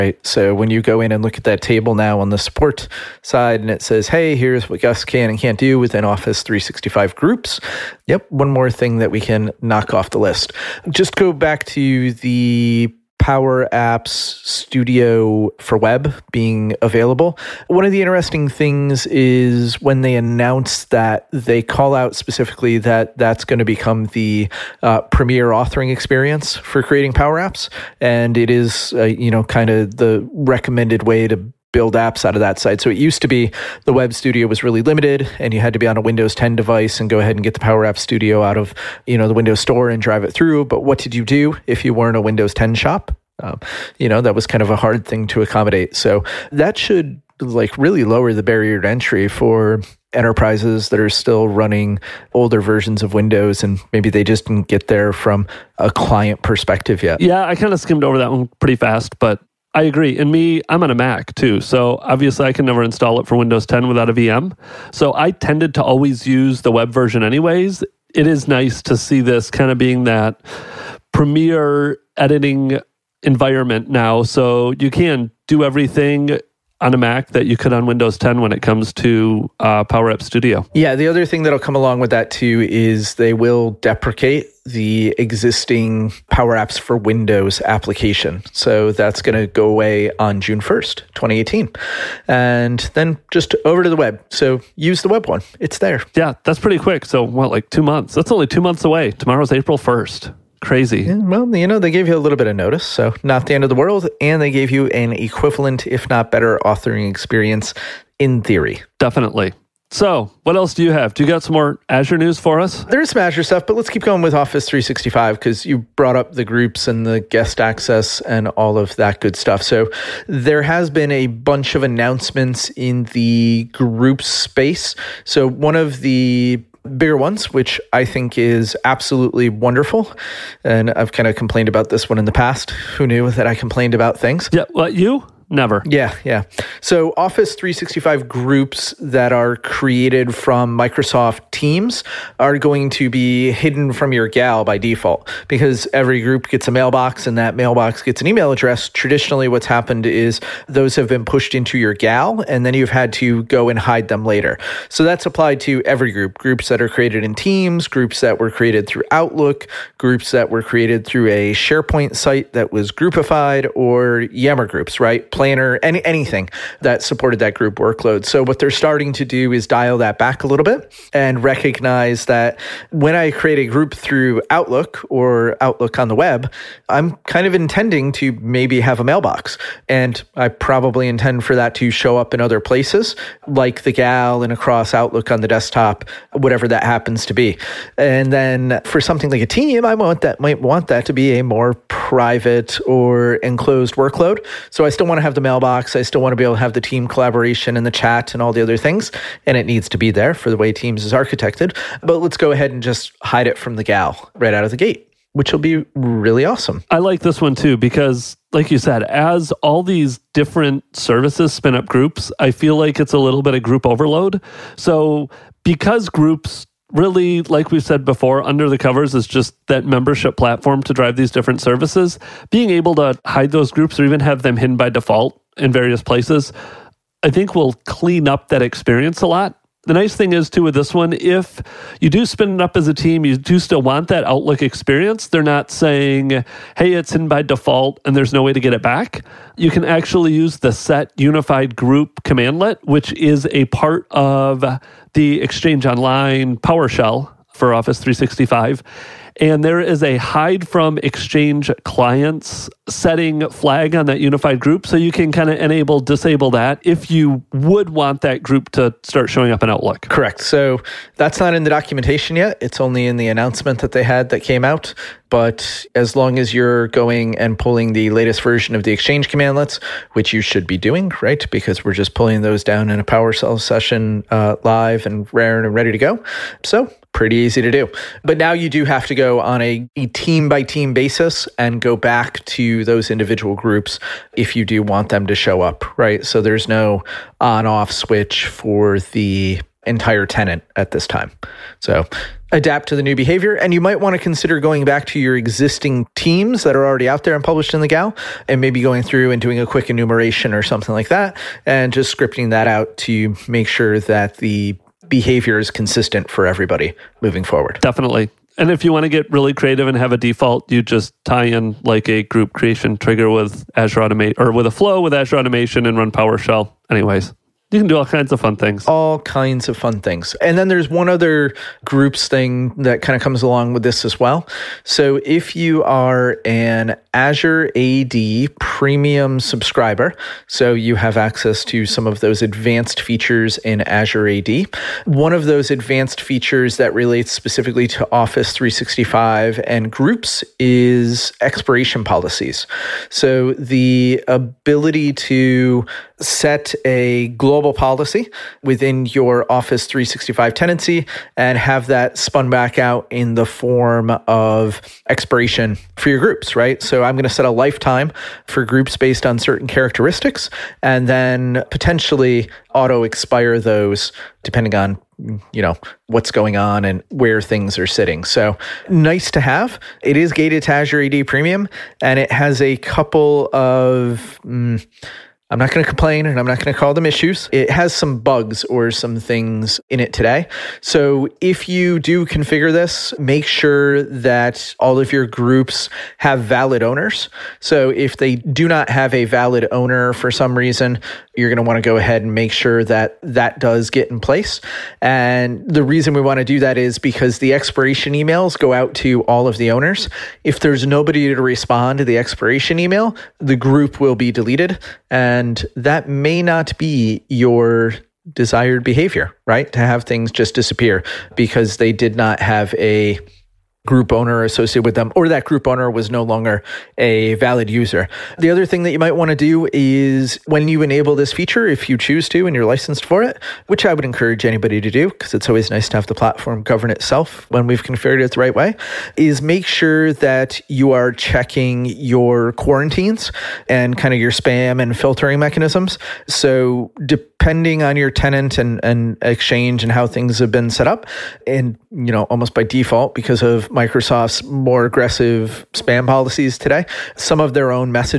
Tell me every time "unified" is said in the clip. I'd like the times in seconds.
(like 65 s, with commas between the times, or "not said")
241 s, 254 s.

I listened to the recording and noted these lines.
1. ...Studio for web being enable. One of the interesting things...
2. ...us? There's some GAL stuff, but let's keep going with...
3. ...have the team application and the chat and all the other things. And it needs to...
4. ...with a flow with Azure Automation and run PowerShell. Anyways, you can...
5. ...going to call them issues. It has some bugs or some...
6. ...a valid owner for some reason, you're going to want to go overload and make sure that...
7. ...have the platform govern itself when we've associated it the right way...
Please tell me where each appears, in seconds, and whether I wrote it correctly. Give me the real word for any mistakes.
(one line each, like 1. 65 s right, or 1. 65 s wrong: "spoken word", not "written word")
1. 14 s wrong: "available", not "enable"
2. 112 s wrong: "Azure", not "GAL"
3. 196 s wrong: "collaboration", not "application"
4. 314 s right
5. 376 s right
6. 389 s wrong: "ahead", not "overload"
7. 425 s wrong: "configured", not "associated".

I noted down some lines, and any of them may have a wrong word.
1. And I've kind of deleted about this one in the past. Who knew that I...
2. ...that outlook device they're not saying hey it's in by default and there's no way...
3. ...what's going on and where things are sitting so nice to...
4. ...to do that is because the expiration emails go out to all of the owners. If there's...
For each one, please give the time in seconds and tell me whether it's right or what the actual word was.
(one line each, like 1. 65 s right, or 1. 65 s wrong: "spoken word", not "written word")
1. 130 s wrong: "complained", not "deleted"
2. 234 s wrong: "experience", not "device"
3. 366 s right
4. 396 s right.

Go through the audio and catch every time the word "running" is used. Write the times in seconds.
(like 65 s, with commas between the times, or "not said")
51 s.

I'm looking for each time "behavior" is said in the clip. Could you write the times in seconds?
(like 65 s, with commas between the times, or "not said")
293 s, 305 s, 408 s.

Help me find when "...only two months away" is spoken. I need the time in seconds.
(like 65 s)
98 s.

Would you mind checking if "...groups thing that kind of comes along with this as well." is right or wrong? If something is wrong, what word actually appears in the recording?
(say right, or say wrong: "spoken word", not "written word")
right.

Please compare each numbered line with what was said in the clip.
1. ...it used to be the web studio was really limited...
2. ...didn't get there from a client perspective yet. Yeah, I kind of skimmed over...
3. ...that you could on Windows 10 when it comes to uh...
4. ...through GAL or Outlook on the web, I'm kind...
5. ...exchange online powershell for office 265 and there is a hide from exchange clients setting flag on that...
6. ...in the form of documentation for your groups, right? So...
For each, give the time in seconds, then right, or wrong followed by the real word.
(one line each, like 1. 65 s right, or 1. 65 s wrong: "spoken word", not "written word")
1. 32 s right
2. 54 s right
3. 77 s right
4. 173 s wrong: "Outlook", not "GAL"
5. 245 s wrong: "365", not "265"
6. 353 s wrong: "expiration", not "documentation".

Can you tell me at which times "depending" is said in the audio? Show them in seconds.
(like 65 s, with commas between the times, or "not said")
364 s, 437 s.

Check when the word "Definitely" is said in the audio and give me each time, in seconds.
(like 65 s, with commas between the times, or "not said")
108 s, 307 s.